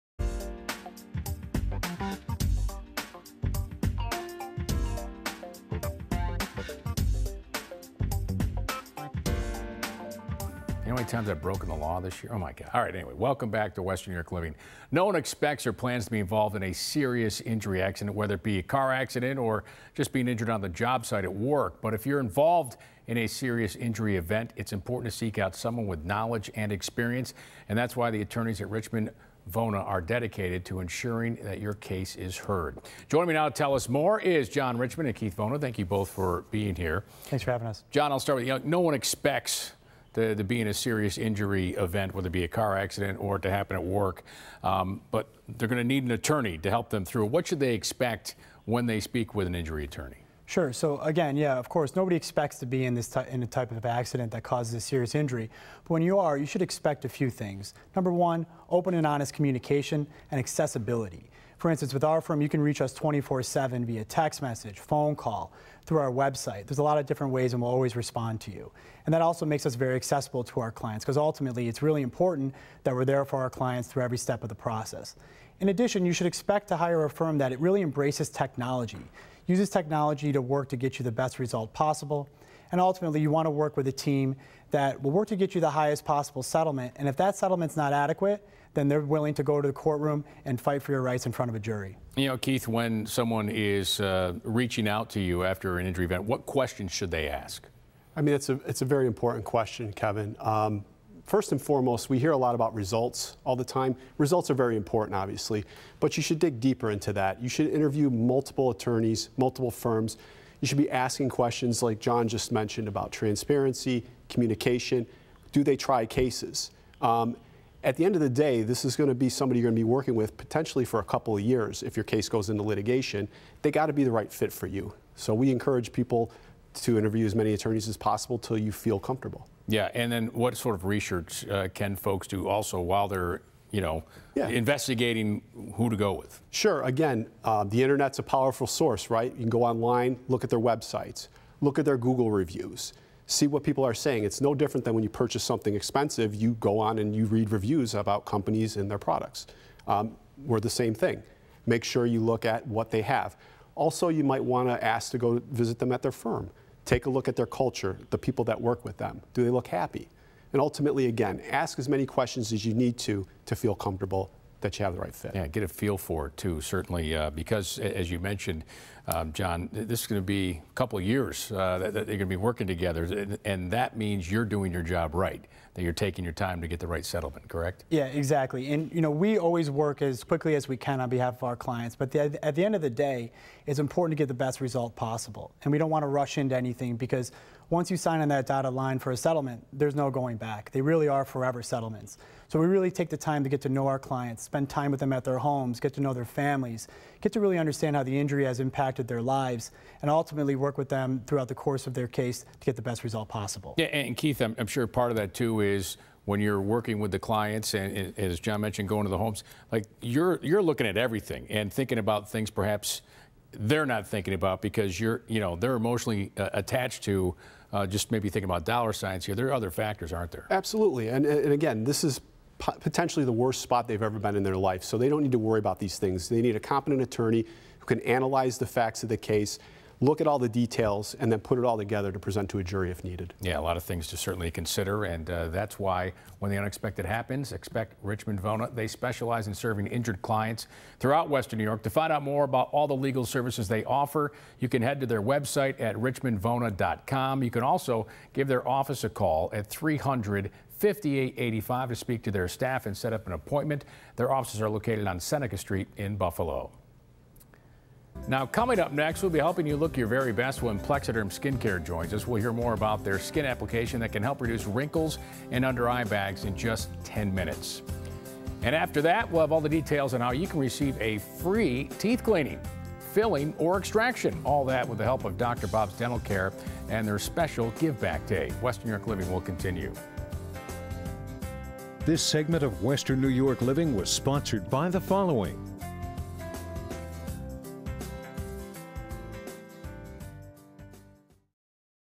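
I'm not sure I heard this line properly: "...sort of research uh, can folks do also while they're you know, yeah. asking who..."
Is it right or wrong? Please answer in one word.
wrong.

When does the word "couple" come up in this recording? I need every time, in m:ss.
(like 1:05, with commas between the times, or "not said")
2:01, 2:50.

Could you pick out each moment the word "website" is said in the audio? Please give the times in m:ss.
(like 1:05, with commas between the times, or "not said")
1:06, 2:20, 4:05.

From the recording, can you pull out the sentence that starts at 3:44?
So they don't need to worry about these things.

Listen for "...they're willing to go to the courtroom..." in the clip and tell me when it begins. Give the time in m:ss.
1:28.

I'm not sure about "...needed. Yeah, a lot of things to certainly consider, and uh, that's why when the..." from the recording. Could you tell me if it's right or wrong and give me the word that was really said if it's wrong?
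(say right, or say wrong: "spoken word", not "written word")
right.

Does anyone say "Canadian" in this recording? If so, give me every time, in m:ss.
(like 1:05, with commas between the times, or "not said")
not said.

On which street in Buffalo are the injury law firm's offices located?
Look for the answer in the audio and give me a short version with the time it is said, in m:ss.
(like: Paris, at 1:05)
Seneca Street, at 4:15.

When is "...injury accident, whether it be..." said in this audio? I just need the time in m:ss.
0:17.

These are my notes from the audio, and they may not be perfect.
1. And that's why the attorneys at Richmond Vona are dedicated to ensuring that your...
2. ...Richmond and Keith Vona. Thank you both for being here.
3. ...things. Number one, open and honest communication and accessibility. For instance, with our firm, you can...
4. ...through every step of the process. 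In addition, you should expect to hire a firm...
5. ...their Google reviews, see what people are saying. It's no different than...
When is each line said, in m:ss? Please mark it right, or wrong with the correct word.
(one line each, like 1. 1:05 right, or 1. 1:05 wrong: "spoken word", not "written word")
1. 0:27 right
2. 0:34 right
3. 0:57 right
4. 1:13 right
5. 2:21 right.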